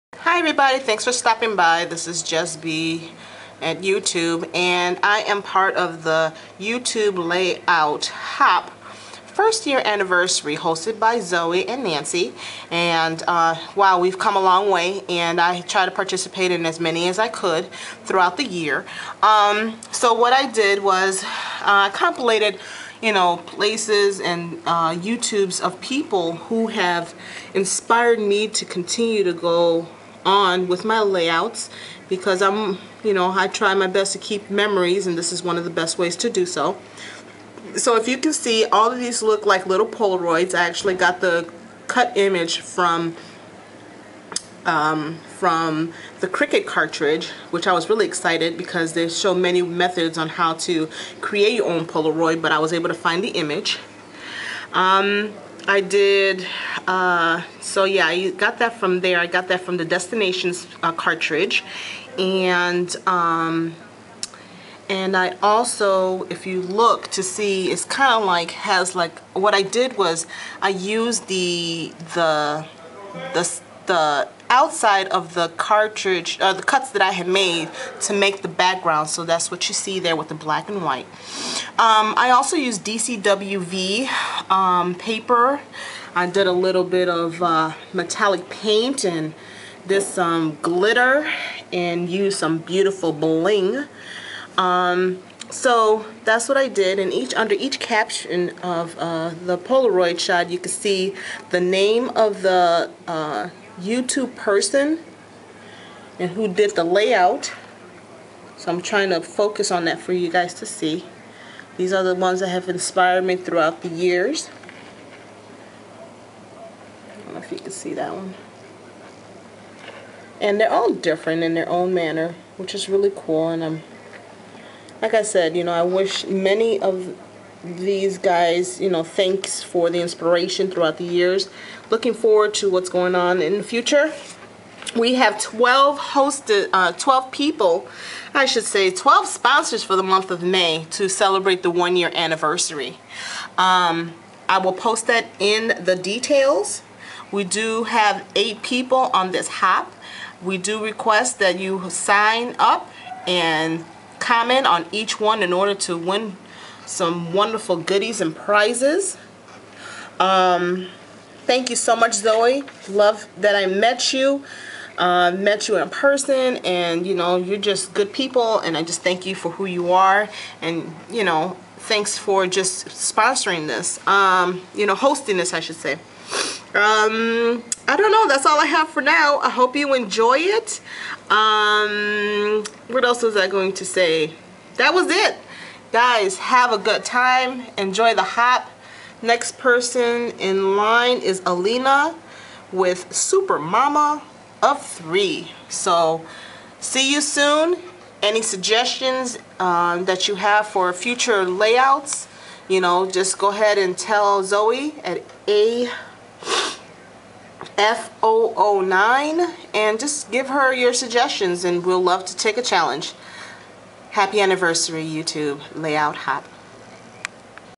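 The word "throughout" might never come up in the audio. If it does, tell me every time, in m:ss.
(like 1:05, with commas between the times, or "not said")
0:18, 1:53, 2:10.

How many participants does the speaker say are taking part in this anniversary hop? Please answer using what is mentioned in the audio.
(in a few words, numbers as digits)
8.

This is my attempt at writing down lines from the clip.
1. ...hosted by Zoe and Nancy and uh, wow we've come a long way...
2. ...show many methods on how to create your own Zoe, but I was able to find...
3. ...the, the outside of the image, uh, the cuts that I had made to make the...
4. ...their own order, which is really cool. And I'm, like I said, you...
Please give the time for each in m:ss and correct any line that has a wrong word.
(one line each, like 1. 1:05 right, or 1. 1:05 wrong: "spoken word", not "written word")
1. 0:10 right
2. 0:49 wrong: "Polaroid", not "Zoe"
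3. 1:13 wrong: "cartridge", not "image"
4. 2:01 wrong: "manner", not "order".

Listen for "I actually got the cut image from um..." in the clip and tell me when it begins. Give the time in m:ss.
0:40.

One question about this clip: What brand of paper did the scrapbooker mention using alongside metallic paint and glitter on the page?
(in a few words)
DCWV.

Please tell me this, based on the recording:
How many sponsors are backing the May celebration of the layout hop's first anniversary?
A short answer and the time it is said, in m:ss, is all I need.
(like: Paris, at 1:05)
12, at 2:18.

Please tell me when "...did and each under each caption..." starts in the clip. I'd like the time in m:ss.
1:36.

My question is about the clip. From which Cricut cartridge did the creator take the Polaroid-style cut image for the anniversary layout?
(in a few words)
Destinations.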